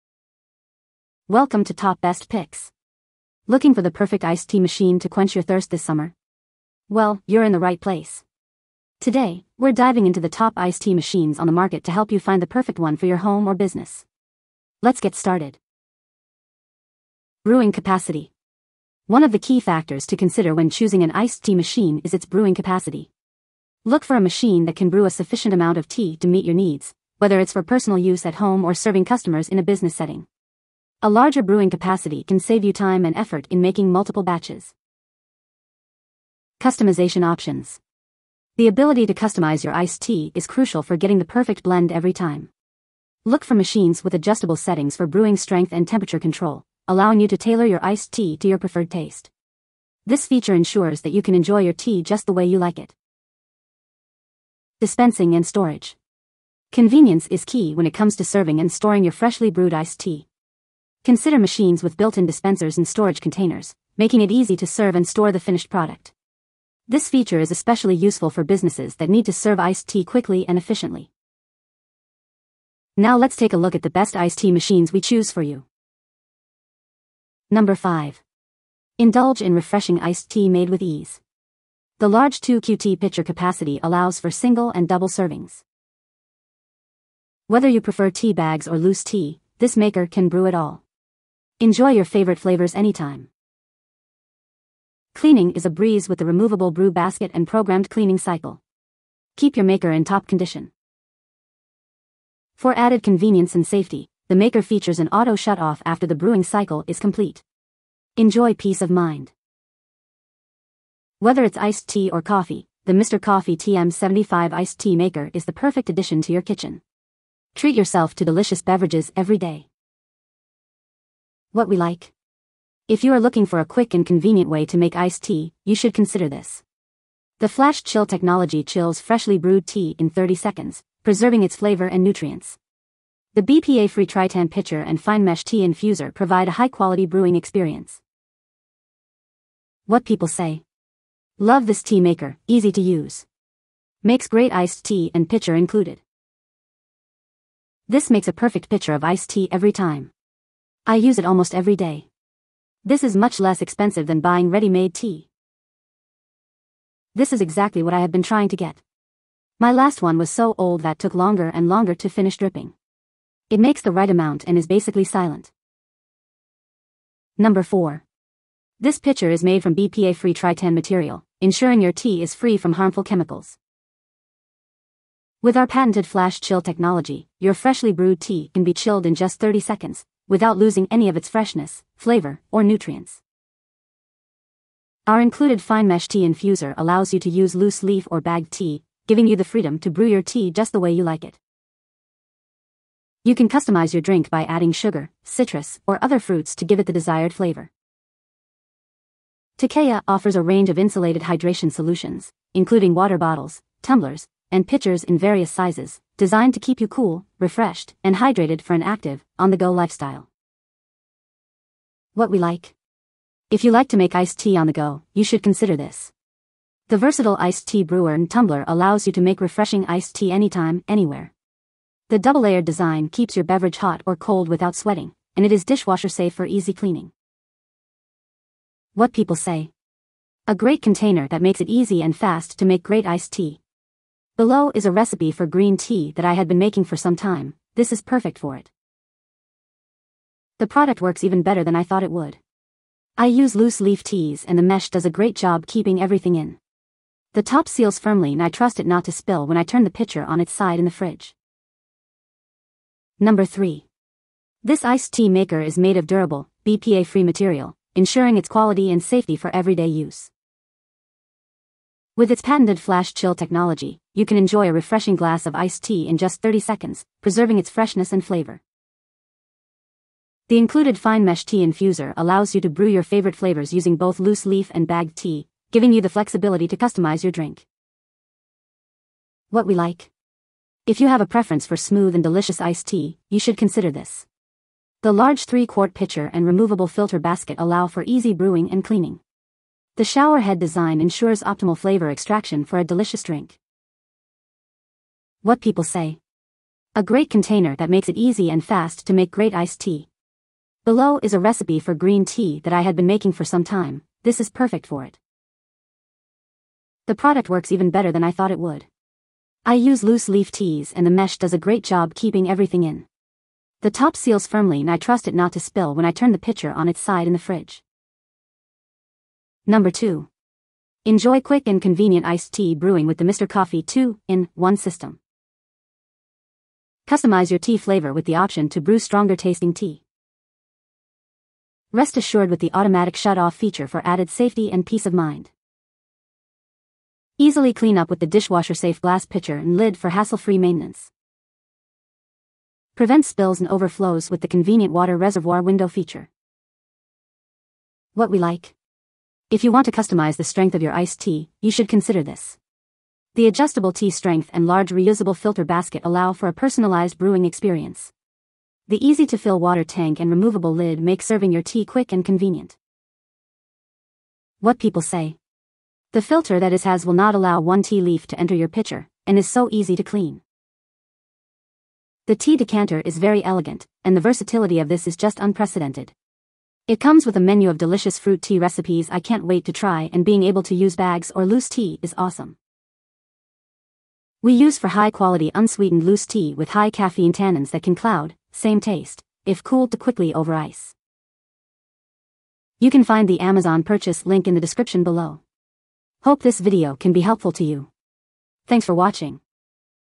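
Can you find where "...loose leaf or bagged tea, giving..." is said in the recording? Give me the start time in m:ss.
3:07.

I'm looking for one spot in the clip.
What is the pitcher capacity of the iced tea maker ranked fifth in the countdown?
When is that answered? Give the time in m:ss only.
1:22.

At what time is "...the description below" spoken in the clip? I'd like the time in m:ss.
6:34.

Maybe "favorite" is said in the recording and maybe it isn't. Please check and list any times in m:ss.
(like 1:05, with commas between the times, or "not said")
1:32, 4:33.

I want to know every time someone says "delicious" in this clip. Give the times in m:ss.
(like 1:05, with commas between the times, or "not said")
1:58, 4:42, 4:52, 6:17.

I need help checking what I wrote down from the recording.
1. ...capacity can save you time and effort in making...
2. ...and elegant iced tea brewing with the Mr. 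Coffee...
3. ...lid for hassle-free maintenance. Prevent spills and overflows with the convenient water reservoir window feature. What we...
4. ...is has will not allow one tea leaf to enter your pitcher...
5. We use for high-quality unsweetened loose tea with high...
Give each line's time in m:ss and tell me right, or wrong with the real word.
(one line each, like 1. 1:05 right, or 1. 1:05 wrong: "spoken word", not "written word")
1. 0:31 right
2. 5:21 wrong: "convenient", not "elegant"
3. 5:39 right
4. 6:06 right
5. 6:24 right.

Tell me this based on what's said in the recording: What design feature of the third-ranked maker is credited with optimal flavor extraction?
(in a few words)
showerhead design.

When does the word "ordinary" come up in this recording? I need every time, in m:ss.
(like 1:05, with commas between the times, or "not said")
not said.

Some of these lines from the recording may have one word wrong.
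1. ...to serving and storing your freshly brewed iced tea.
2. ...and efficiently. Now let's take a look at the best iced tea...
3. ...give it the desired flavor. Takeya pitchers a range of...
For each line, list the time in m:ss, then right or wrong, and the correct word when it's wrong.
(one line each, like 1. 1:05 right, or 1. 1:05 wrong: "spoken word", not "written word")
1. 0:58 right
2. 1:10 right
3. 3:16 wrong: "offers", not "pitchers".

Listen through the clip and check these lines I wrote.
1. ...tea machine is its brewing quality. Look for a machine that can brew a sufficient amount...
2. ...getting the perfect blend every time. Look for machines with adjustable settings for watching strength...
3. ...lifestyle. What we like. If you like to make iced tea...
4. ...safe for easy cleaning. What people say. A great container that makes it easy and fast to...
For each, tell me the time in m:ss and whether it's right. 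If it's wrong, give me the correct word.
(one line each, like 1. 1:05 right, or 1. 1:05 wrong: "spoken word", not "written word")
1. 0:21 wrong: "capacity", not "quality"
2. 0:40 wrong: "brewing", not "watching"
3. 3:29 right
4. 3:46 right.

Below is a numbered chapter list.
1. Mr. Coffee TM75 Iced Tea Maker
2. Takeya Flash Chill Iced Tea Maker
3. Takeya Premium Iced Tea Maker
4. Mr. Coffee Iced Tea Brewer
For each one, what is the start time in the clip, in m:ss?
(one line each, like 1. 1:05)
1. 1:16
2. 2:46
3. 4:11
4. 5:18.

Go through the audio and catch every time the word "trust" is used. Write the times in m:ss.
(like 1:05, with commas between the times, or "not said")
4:08, 5:14.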